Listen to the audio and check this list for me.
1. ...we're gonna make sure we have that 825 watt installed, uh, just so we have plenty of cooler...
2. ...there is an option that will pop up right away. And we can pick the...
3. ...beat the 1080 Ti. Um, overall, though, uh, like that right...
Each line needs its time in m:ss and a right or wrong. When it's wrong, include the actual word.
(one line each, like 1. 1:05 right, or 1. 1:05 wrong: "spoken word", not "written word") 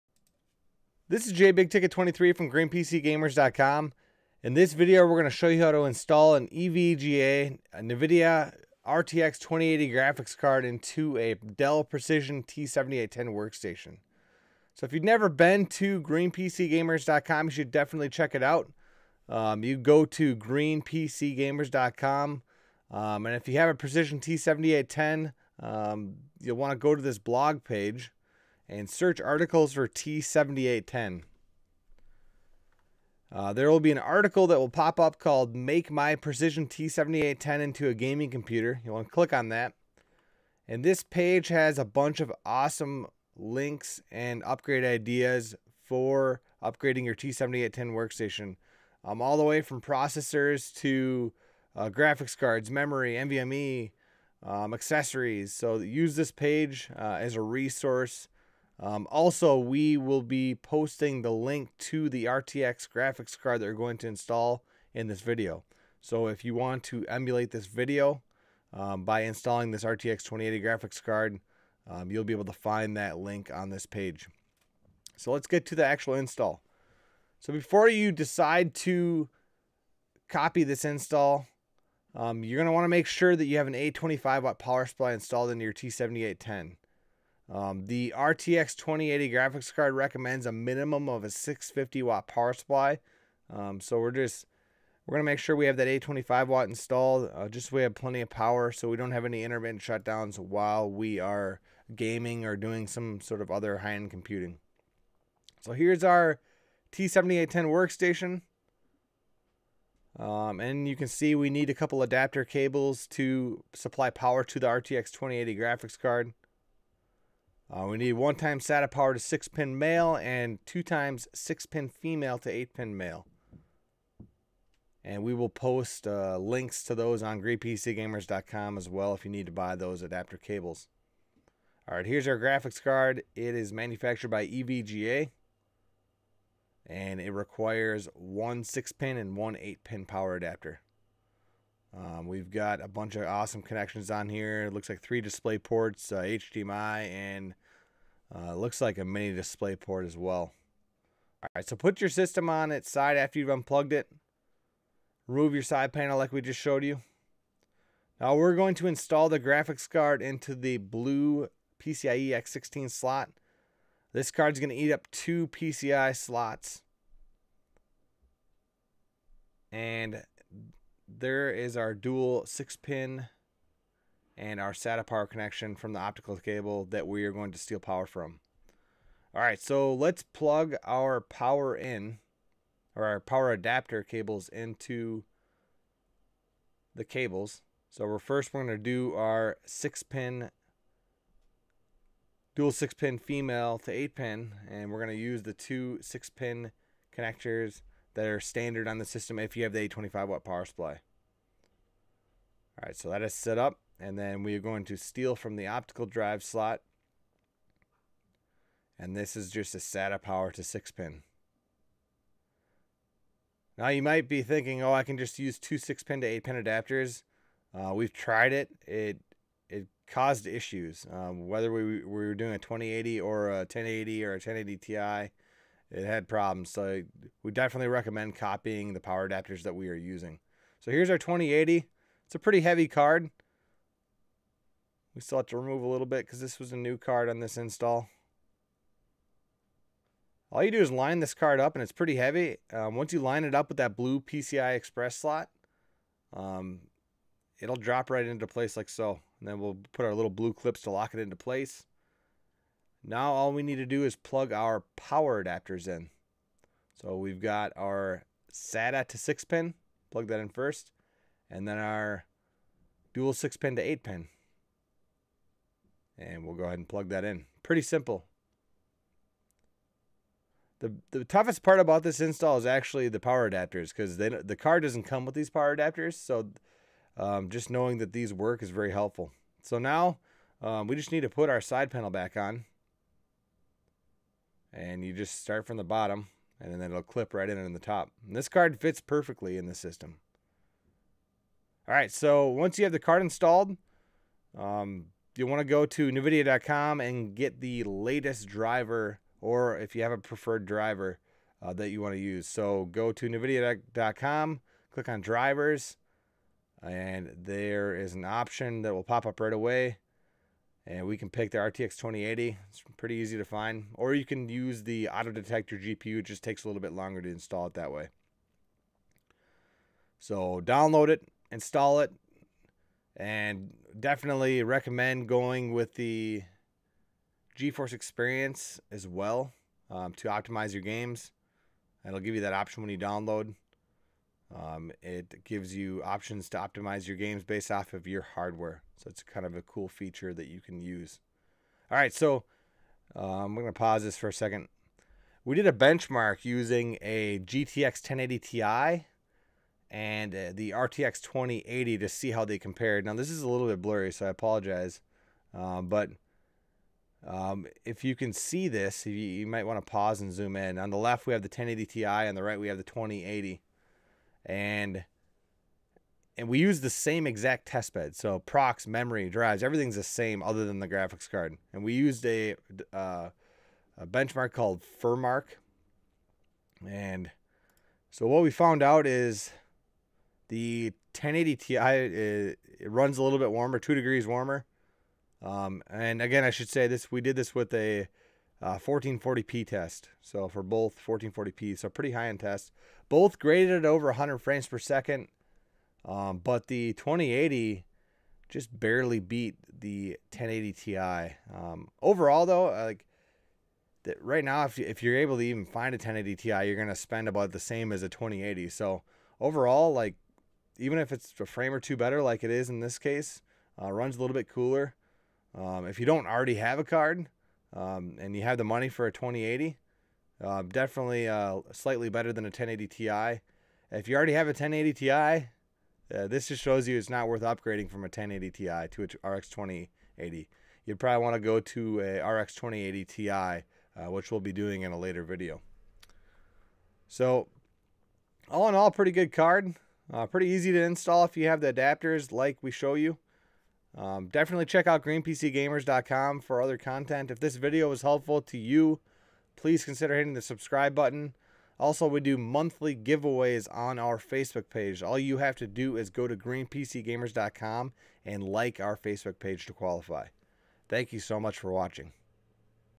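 1. 1:35 wrong: "power", not "cooler"
2. 5:07 right
3. 6:39 right.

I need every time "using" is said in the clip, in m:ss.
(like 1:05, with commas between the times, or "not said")
3:49, 5:46.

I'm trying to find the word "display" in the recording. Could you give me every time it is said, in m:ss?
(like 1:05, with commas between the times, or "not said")
2:25, 2:29.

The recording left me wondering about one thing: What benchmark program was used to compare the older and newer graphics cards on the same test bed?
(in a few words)
Furmark.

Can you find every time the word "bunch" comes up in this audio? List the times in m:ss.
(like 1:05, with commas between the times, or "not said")
0:41, 2:22.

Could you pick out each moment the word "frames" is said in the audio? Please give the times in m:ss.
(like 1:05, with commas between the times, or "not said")
6:34, 6:51.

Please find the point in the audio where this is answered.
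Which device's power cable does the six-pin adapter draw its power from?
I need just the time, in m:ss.
3:25.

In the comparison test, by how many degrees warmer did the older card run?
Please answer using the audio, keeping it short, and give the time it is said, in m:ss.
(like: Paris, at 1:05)
2 degrees, at 6:23.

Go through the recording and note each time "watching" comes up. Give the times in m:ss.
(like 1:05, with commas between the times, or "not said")
7:41.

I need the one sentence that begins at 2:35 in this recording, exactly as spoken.
Remove your side panel like we just showed you.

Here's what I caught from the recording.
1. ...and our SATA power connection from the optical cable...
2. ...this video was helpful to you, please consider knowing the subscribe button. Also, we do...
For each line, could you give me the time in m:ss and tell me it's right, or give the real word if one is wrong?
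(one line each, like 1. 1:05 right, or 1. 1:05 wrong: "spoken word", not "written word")
1. 2:54 right
2. 7:27 wrong: "hitting", not "knowing".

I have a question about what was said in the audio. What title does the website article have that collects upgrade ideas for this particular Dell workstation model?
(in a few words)
Make My Precision T7810 into a Gaming Computer.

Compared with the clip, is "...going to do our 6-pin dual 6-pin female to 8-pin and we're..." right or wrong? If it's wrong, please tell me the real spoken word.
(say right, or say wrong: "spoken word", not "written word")
right.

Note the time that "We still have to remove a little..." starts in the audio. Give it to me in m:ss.
3:55.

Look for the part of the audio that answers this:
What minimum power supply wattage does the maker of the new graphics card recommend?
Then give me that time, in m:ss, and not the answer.
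1:31.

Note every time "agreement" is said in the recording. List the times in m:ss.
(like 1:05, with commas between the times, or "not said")
not said.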